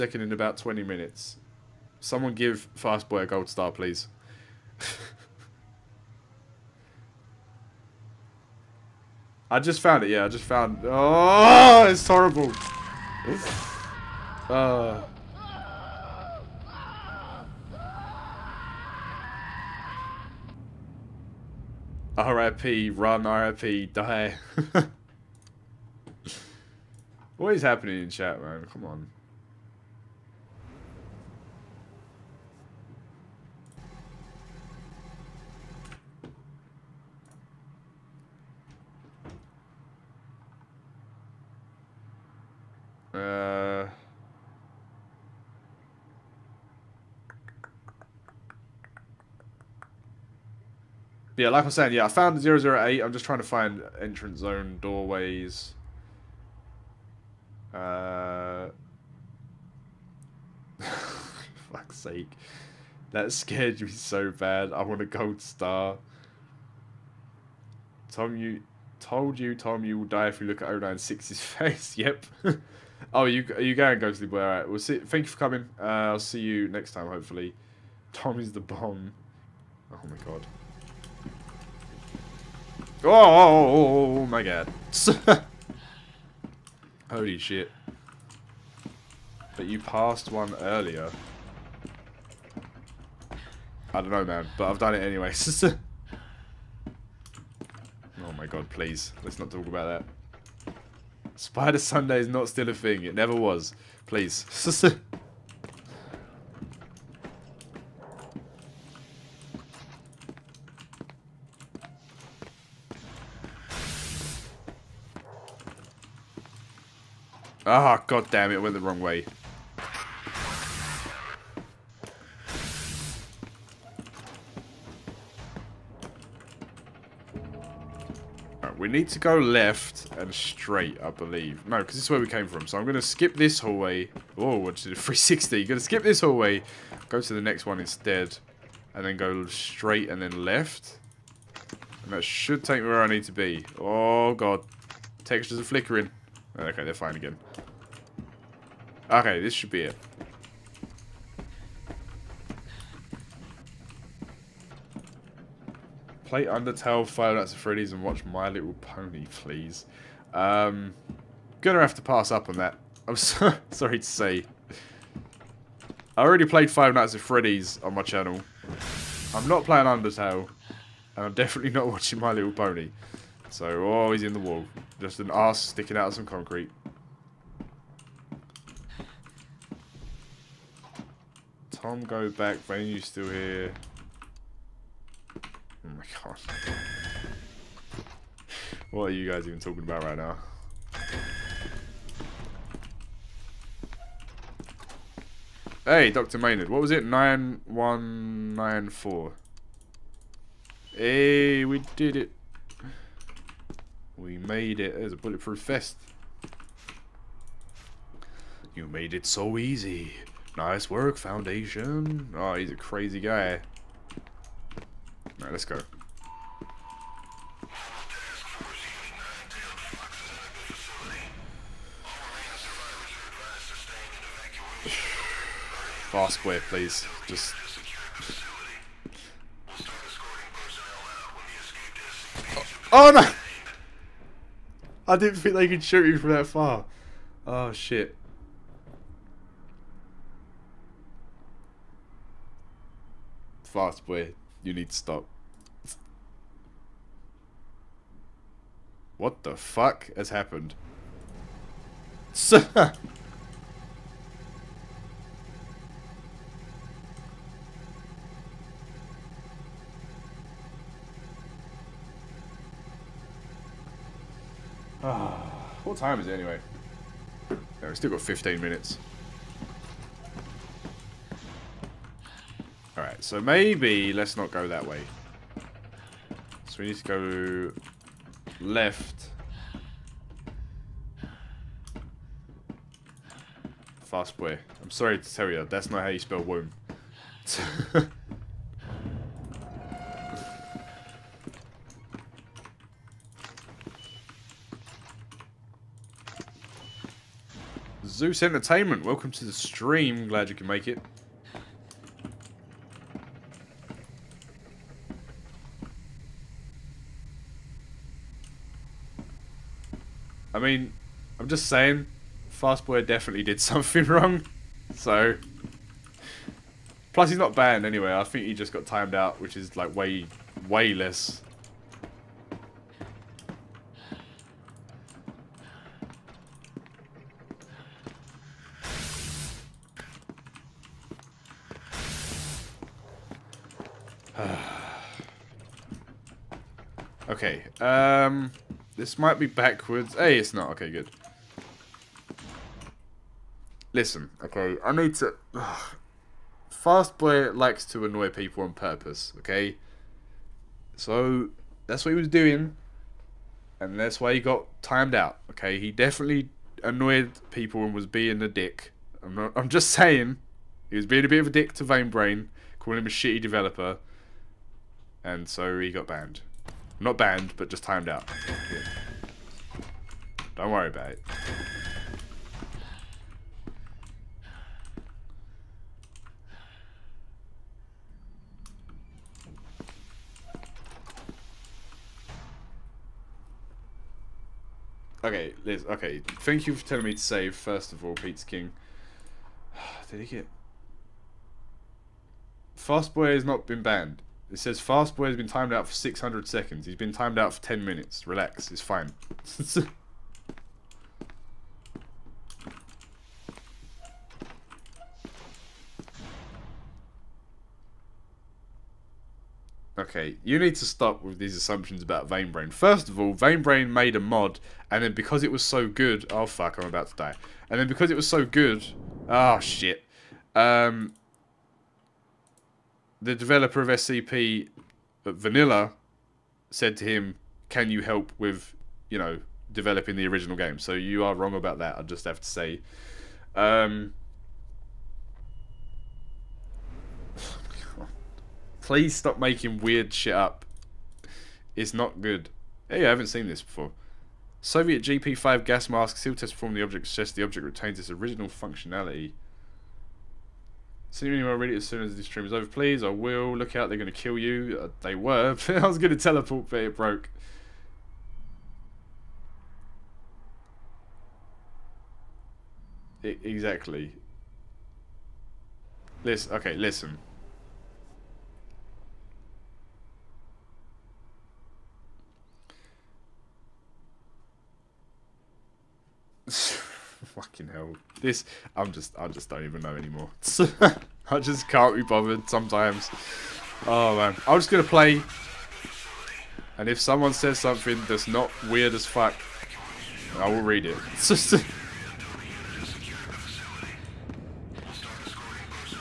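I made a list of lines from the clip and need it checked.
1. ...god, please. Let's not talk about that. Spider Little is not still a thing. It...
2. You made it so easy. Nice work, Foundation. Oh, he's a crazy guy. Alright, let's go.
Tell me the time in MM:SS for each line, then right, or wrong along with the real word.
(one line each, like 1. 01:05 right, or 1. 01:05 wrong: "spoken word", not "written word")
1. 01:38 wrong: "Sunday", not "Little"
2. 03:28 right.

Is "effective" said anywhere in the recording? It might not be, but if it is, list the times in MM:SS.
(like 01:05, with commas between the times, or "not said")
not said.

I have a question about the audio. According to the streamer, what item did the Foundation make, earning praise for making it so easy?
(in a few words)
bulletproof vest.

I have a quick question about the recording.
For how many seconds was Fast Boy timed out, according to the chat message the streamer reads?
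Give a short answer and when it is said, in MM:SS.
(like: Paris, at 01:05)
600, at 06:35.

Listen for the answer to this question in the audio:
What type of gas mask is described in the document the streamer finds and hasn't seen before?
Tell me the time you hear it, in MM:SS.
07:24.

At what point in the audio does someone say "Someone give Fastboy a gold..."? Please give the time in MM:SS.
00:01.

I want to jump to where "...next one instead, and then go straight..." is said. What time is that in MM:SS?
02:17.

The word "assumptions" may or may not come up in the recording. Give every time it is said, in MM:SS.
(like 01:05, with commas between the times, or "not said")
06:51.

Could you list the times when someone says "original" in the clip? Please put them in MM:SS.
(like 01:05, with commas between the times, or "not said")
07:10, 07:28.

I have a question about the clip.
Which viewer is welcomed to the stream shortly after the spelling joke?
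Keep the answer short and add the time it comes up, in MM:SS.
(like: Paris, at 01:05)
Zeus Entertainment, at 04:58.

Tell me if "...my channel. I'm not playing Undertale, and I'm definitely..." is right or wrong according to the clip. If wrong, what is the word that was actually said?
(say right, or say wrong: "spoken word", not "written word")
right.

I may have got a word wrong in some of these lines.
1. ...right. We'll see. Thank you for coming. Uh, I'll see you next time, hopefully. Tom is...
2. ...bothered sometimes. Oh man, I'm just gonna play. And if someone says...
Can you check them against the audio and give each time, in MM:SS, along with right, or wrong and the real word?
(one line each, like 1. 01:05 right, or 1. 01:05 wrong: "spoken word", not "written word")
1. 01:14 right
2. 08:02 right.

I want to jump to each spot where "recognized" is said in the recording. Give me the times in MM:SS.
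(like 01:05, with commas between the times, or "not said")
not said.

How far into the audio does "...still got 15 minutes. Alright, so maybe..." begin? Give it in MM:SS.
04:27.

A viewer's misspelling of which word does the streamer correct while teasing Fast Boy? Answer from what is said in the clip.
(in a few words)
womb.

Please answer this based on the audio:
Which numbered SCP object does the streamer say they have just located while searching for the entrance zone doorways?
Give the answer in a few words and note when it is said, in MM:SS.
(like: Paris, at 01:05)
008, at 00:52.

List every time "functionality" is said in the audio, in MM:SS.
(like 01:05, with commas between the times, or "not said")
07:28.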